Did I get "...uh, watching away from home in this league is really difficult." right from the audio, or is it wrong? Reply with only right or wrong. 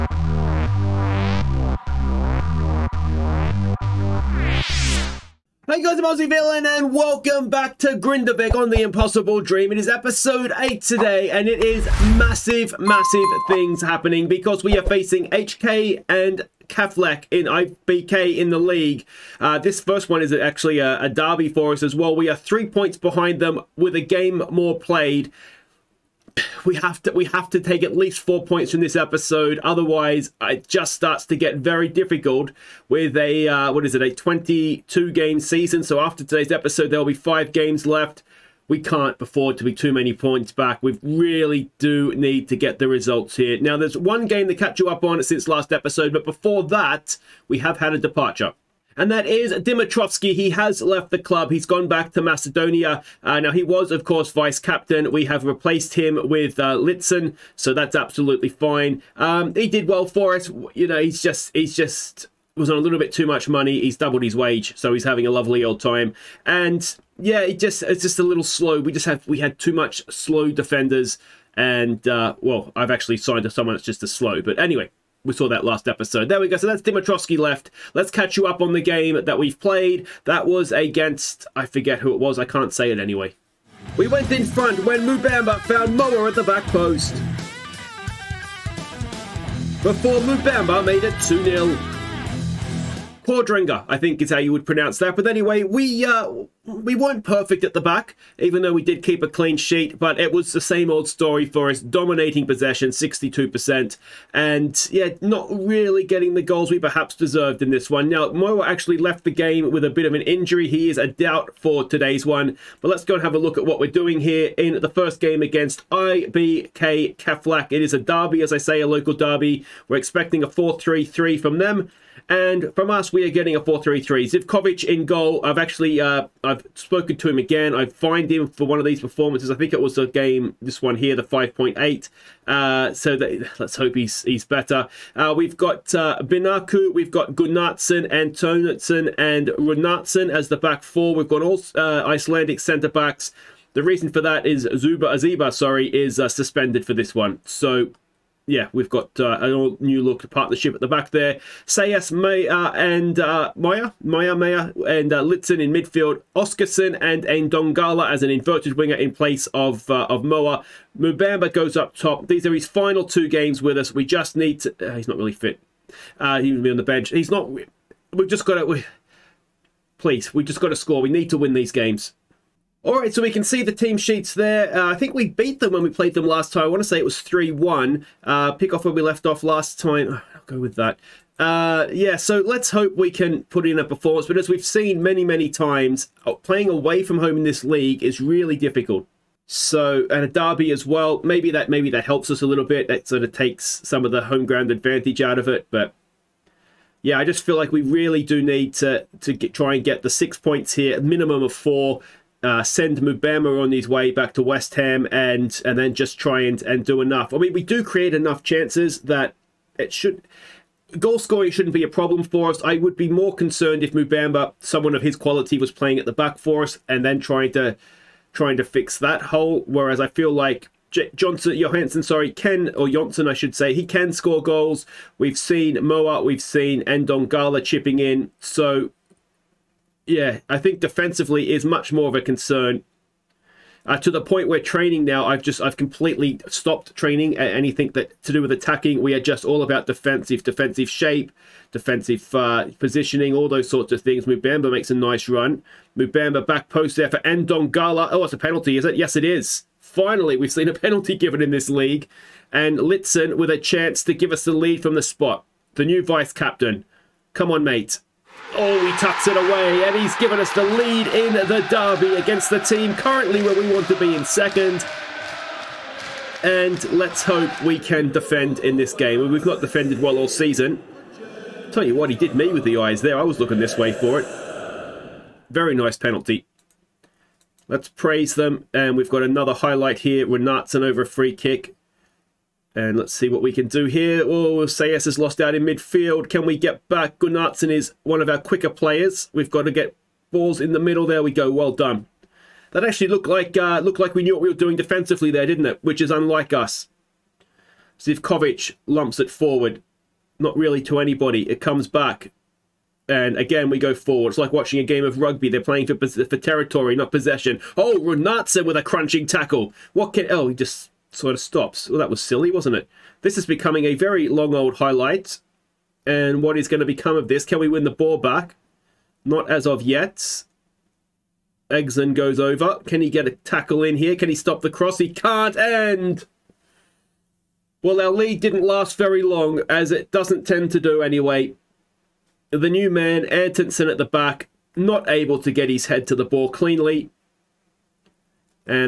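wrong.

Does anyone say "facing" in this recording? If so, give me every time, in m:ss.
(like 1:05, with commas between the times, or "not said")
0:14.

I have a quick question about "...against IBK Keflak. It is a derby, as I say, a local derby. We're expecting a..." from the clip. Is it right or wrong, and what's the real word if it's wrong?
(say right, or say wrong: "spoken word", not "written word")
right.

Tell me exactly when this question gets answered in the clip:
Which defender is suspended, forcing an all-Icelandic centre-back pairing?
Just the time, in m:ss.
2:24.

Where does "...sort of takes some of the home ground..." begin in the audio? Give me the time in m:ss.
3:13.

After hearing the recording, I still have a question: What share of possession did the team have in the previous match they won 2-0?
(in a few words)
62%.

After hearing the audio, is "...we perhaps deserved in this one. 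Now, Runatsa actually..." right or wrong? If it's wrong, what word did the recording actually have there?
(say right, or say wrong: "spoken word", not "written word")
wrong: "Moira", not "Runatsa".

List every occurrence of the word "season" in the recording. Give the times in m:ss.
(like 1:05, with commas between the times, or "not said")
0:35, 4:30.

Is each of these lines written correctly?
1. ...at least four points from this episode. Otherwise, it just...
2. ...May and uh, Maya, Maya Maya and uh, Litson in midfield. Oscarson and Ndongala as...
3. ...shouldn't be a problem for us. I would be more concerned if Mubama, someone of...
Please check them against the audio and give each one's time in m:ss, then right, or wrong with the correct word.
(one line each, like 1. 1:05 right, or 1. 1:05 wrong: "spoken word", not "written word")
1. 0:27 right
2. 2:32 right
3. 3:31 right.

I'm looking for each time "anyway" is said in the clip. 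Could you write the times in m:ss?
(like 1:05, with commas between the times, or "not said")
1:14, 1:22, 1:35, 5:31.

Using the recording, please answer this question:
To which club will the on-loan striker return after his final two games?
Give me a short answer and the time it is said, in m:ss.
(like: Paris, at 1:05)
West Ham, at 3:24.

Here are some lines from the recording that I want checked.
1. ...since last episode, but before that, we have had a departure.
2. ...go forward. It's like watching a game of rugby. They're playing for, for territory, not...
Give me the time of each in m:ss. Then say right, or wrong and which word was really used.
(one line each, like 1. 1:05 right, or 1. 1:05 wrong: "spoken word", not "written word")
1. 0:45 right
2. 5:03 right.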